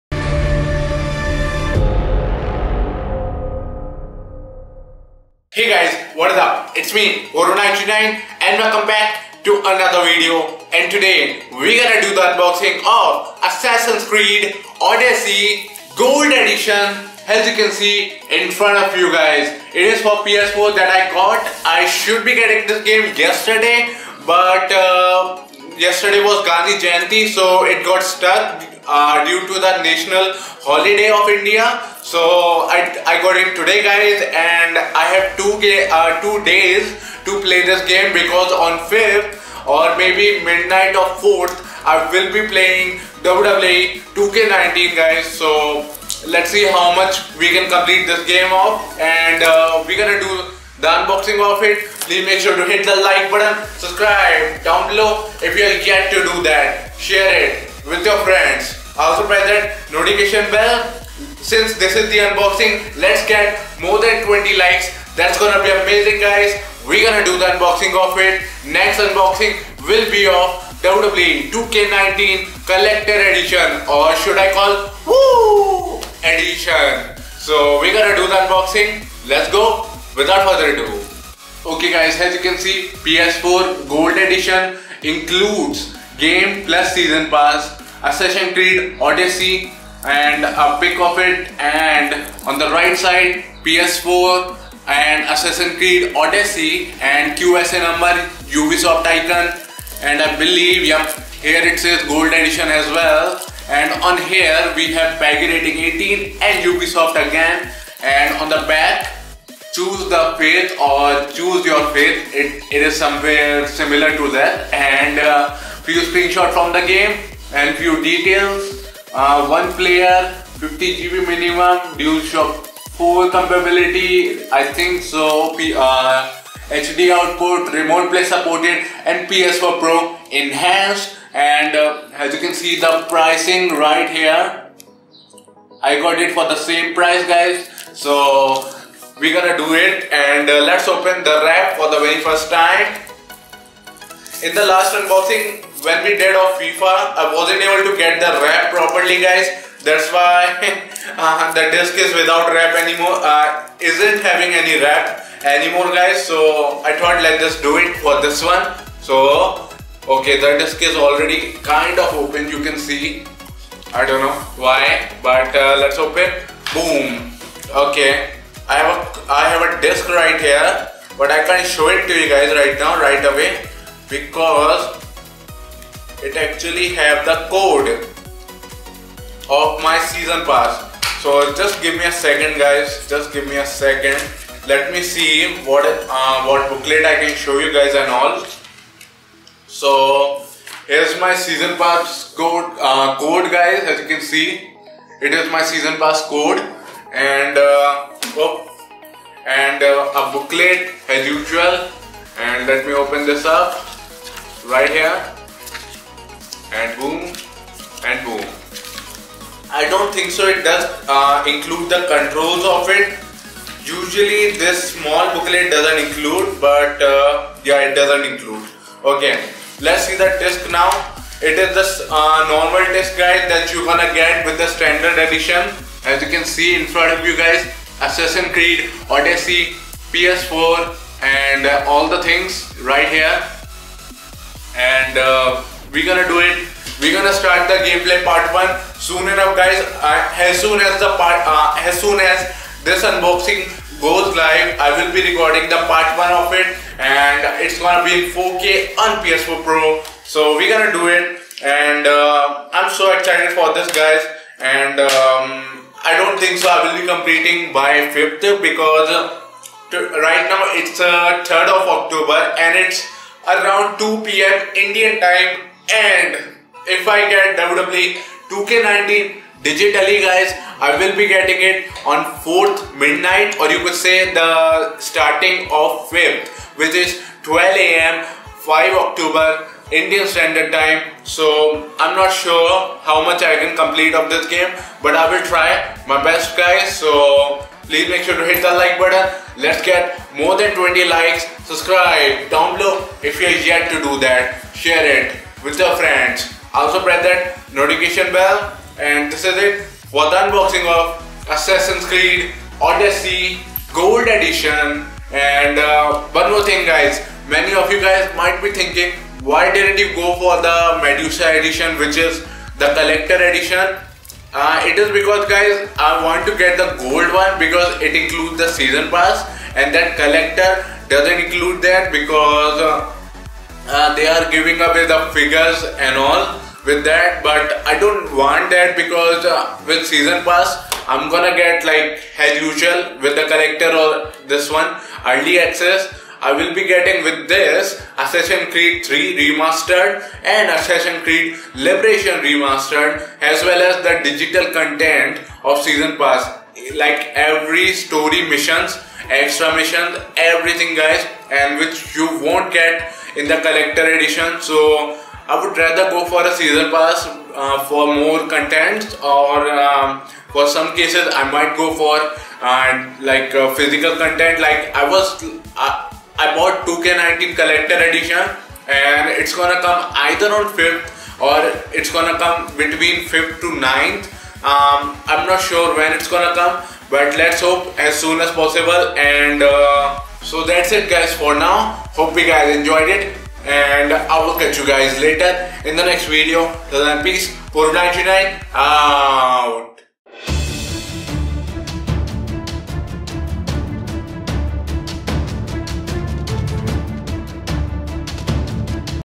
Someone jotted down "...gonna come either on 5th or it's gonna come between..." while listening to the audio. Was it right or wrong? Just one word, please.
right.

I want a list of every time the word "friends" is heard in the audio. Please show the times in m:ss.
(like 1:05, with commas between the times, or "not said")
0:58, 4:55.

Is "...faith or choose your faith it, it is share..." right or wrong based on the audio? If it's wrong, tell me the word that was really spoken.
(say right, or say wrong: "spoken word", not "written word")
wrong: "somewhere", not "share".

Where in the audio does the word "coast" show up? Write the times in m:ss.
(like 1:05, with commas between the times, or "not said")
not said.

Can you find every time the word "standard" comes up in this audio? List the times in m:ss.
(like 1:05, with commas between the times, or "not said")
3:44, 4:40.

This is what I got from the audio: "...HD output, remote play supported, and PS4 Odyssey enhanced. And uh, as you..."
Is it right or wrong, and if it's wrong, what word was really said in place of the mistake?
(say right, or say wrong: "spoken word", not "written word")
wrong: "Pro", not "Odyssey".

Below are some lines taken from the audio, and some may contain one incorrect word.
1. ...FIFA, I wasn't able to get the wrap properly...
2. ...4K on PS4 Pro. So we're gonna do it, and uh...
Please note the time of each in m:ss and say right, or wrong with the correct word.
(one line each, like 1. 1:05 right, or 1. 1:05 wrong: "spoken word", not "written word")
1. 2:26 right
2. 4:08 right.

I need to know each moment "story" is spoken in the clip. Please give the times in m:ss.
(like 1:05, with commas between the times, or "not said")
5:47.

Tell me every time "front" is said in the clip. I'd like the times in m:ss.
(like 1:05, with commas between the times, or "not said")
0:18, 3:46.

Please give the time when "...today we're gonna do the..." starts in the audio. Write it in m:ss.
0:10.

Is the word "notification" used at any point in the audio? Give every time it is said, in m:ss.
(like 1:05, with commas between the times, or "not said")
0:59, 4:57.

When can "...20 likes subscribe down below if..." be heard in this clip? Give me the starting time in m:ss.
4:50.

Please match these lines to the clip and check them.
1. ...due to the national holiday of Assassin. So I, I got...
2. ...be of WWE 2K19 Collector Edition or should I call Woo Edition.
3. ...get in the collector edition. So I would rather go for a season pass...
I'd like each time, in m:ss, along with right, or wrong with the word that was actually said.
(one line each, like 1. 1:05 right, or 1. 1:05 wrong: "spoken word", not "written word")
1. 0:29 wrong: "India", not "Assassin"
2. 1:10 right
3. 5:52 right.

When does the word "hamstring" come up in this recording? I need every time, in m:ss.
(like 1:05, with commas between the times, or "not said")
not said.